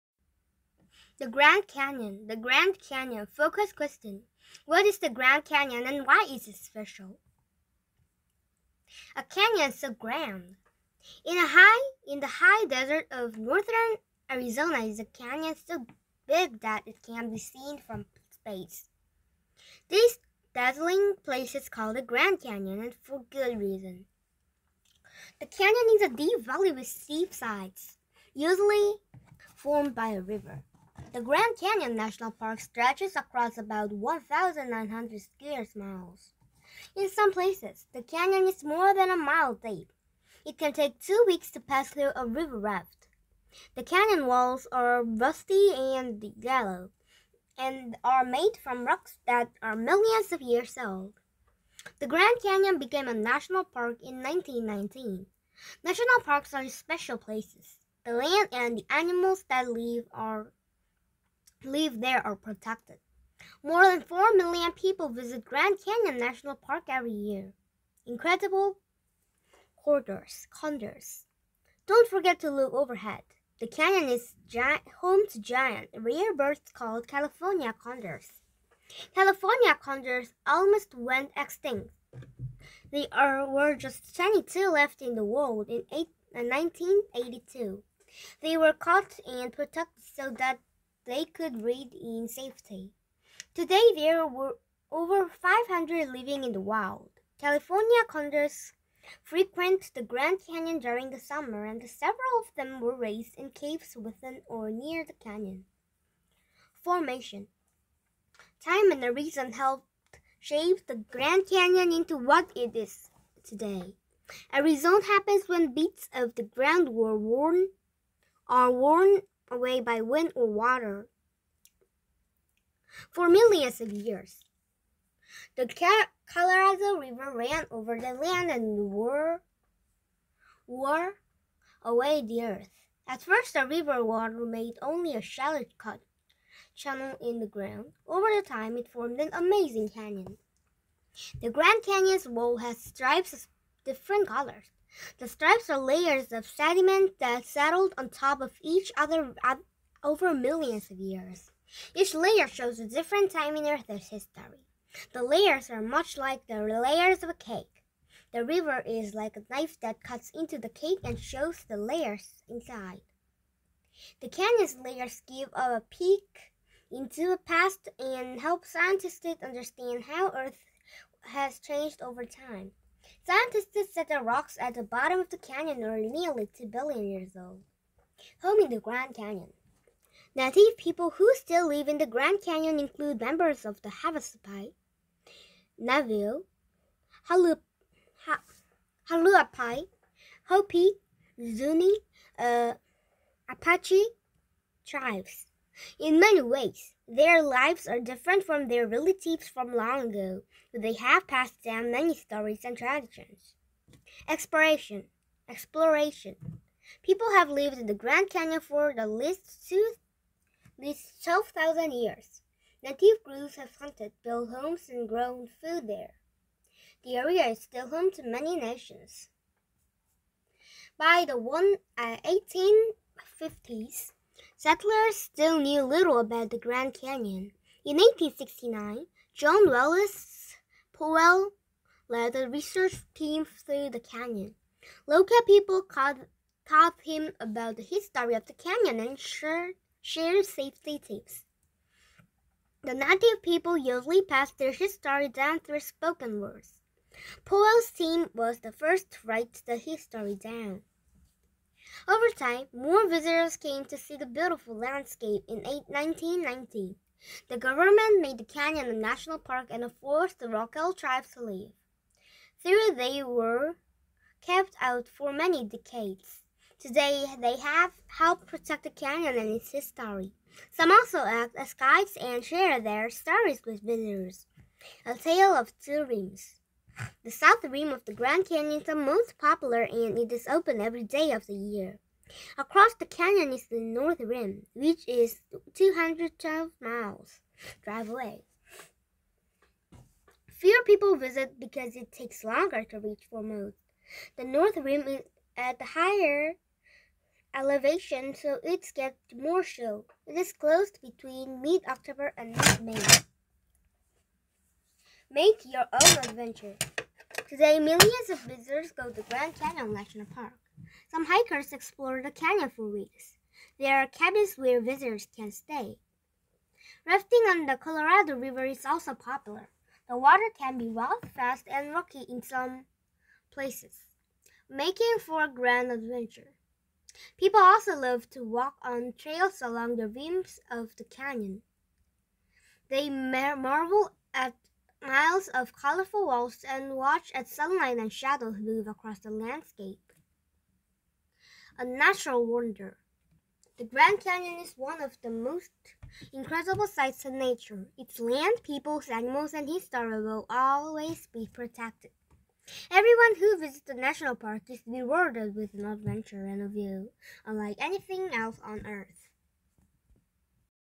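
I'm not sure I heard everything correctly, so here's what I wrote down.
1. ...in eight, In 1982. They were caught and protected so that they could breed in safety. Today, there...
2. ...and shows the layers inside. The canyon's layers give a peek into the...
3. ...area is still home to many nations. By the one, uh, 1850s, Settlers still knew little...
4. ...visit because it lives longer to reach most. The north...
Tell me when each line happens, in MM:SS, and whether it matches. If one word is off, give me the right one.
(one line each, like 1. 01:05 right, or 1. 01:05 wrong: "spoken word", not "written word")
1. 01:25 right
2. 02:41 right
3. 03:37 right
4. 04:51 wrong: "takes", not "lives".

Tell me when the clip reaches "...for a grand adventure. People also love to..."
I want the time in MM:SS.
05:25.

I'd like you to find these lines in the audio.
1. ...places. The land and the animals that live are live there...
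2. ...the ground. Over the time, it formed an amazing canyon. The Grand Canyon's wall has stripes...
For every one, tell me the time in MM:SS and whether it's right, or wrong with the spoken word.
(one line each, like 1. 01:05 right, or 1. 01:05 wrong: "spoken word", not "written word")
1. 00:57 right
2. 02:17 right.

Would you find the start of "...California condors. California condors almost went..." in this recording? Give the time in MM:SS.
01:17.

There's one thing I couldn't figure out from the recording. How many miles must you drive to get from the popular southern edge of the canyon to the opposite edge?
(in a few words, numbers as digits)
212 miles.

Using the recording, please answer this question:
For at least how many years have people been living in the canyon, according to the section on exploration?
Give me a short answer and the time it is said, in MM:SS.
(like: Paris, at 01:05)
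12,000 years, at 03:31.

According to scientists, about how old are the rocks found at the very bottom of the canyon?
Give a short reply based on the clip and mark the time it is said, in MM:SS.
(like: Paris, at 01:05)
nearly 2 billion years, at 02:55.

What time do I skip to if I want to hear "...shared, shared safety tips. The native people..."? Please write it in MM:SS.
03:59.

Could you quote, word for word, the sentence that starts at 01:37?
California condors frequent the Grand Canyon during the summer, and several of them were raised in caves within or near the canyon.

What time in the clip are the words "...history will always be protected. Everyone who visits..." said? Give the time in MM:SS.
05:49.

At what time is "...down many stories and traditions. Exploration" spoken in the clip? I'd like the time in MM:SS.
03:21.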